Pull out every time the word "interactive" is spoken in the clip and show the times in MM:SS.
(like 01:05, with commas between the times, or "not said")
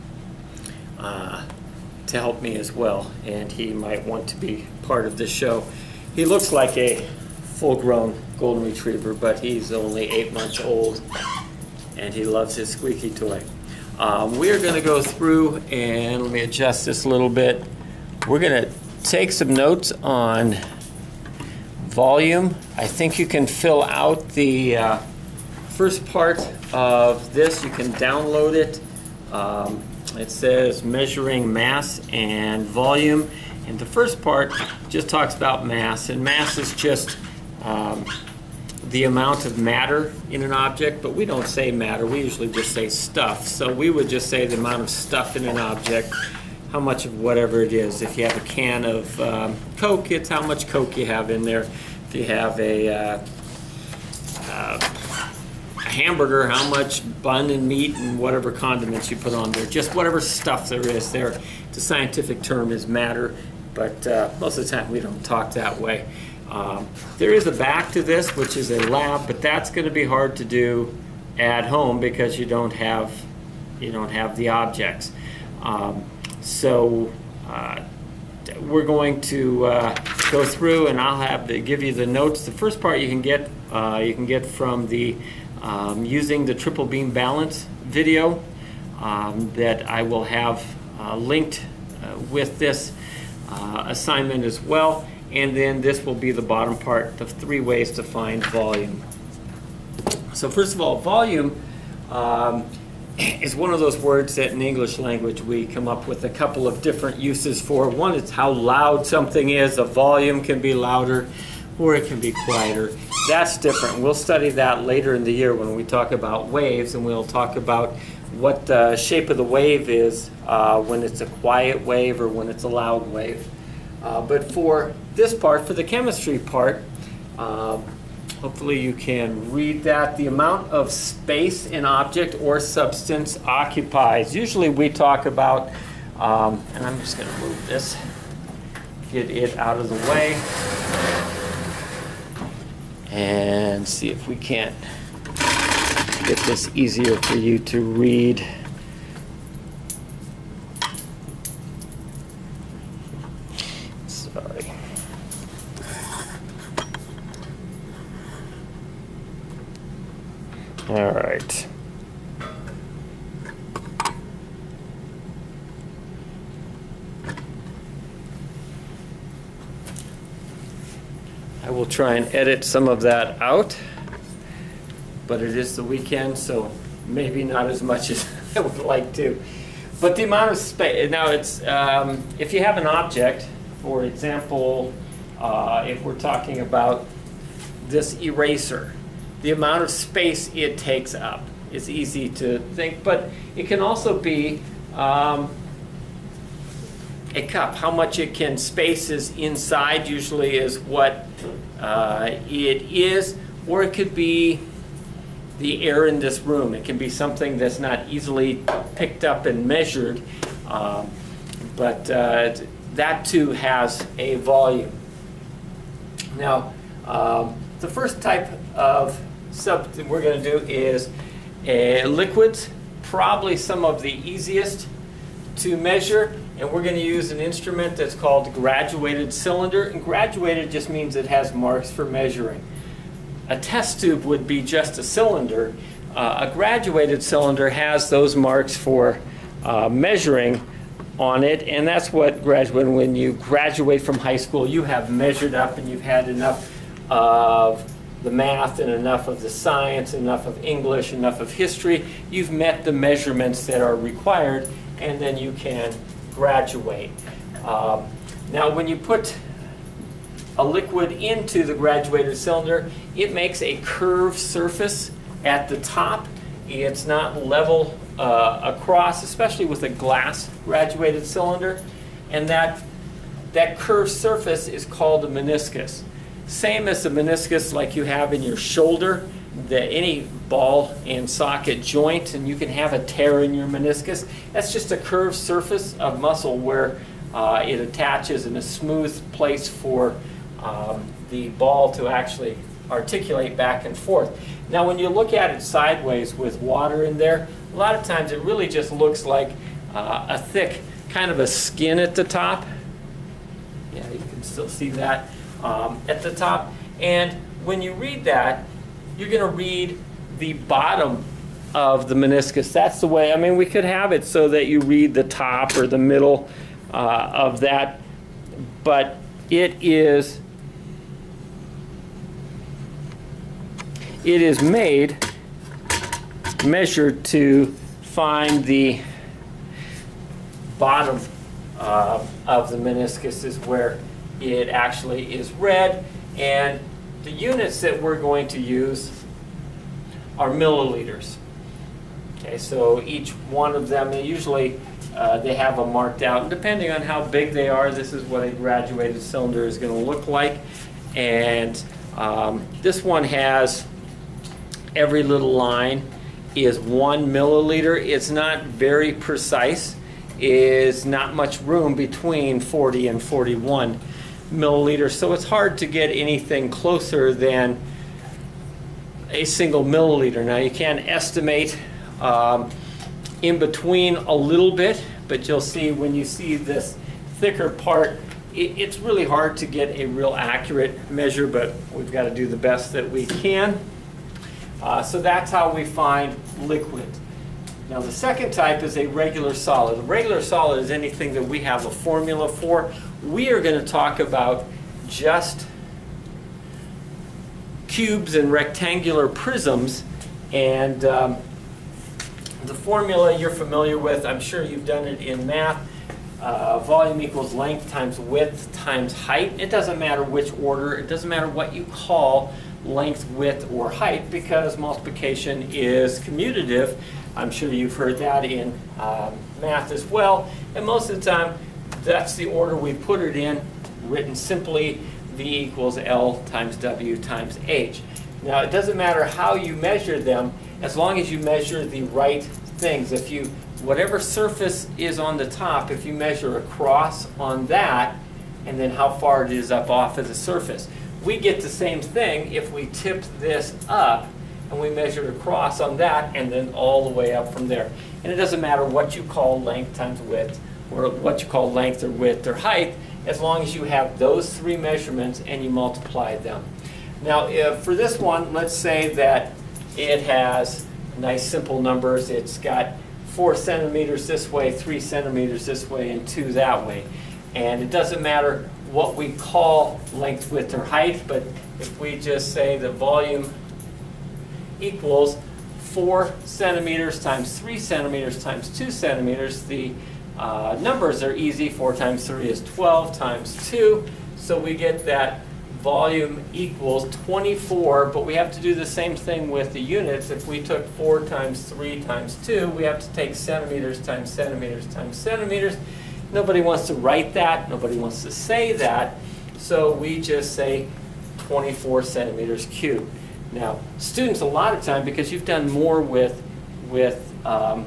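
not said.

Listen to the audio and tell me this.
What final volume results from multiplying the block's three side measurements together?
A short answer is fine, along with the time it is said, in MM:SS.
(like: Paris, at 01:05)
24 centimeters cubed, at 08:21.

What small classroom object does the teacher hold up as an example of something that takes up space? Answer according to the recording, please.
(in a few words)
eraser.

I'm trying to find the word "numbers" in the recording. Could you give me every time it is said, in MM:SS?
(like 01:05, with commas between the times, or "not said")
07:41, 08:00.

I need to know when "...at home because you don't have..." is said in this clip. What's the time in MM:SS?
01:11.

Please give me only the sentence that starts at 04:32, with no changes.
And that, that curved surface is called a meniscus.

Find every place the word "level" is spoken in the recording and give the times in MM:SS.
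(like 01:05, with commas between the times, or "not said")
04:27.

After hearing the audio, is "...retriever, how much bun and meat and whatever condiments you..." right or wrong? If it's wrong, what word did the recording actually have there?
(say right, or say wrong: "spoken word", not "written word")
wrong: "hamburger", not "retriever".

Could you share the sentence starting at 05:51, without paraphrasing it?
And um, this one has every little line is one milliliter.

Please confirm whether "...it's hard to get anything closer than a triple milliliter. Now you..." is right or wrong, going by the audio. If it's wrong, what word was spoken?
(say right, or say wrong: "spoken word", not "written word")
wrong: "single", not "triple".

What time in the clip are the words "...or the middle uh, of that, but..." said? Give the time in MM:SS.
05:15.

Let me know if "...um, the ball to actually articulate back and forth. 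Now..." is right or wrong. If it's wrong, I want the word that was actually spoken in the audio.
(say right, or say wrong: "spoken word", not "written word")
right.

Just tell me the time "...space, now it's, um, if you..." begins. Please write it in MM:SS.
03:00.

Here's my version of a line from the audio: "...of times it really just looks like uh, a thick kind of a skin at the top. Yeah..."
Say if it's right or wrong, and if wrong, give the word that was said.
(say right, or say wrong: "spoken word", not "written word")
right.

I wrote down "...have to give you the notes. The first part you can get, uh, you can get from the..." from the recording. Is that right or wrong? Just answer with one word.
right.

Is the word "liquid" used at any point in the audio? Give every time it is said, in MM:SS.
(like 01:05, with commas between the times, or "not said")
03:42, 04:20, 06:26.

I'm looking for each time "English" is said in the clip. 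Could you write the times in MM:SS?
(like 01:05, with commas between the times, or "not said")
01:44, 04:10.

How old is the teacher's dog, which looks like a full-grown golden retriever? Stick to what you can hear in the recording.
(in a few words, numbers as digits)
8 months.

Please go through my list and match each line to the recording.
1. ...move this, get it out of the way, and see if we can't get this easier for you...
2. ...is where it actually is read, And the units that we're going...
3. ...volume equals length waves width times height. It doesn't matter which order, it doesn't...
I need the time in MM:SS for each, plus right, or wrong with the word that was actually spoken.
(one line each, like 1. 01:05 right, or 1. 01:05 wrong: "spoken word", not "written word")
1. 02:17 right
2. 05:33 right
3. 06:46 wrong: "times", not "waves".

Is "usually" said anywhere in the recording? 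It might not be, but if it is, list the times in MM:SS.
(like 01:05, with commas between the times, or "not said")
00:42, 02:14, 03:20, 05:44.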